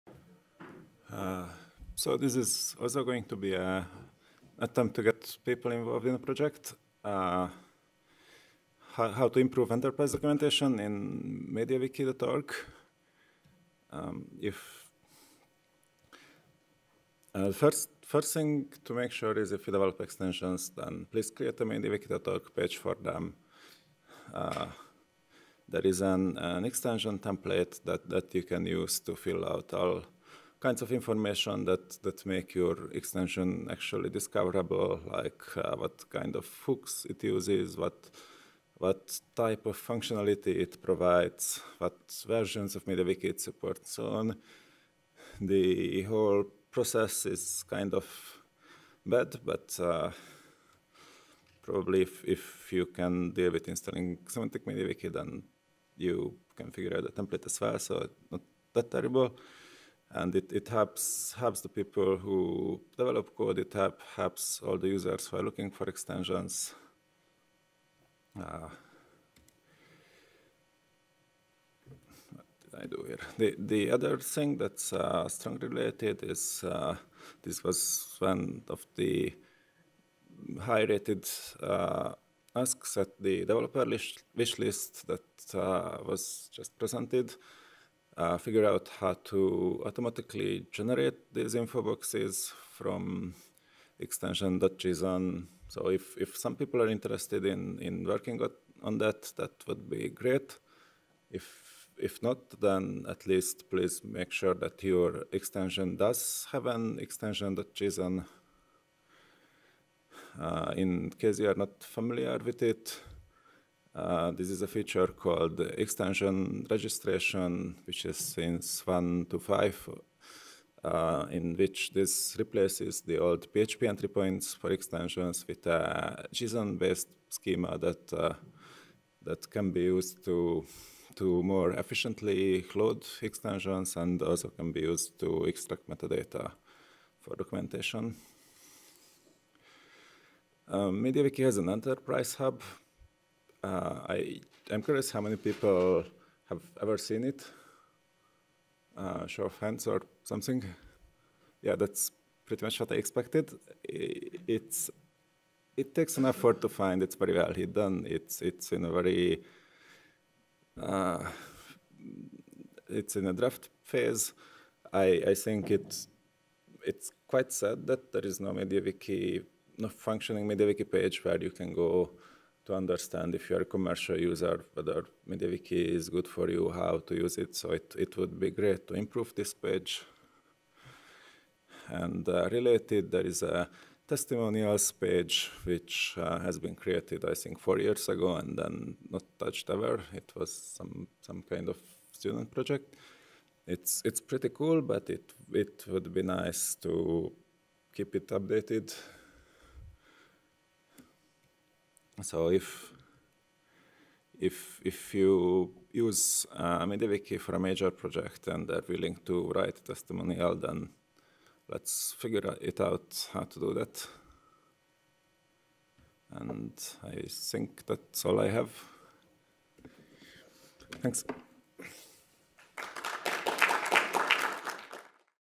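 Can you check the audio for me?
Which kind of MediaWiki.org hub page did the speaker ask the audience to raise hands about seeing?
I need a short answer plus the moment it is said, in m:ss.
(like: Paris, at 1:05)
enterprise hub, at 2:21.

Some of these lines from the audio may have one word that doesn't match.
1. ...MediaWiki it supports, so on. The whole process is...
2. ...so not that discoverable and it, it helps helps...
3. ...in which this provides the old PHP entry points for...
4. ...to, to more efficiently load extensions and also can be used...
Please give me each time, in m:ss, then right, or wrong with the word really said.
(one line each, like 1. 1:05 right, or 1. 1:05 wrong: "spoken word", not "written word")
1. 0:42 right
2. 0:57 wrong: "terrible", not "discoverable"
3. 2:01 wrong: "replaces", not "provides"
4. 2:10 right.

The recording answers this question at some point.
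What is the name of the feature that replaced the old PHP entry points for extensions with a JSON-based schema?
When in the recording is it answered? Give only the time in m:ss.
1:55.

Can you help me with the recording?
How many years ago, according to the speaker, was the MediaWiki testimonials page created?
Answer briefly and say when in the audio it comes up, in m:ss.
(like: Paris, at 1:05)
4, at 3:07.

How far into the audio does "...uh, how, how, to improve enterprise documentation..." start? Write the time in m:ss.
0:07.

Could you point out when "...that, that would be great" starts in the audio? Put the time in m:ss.
1:38.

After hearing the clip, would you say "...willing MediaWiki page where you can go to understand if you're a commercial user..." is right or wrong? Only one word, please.
wrong.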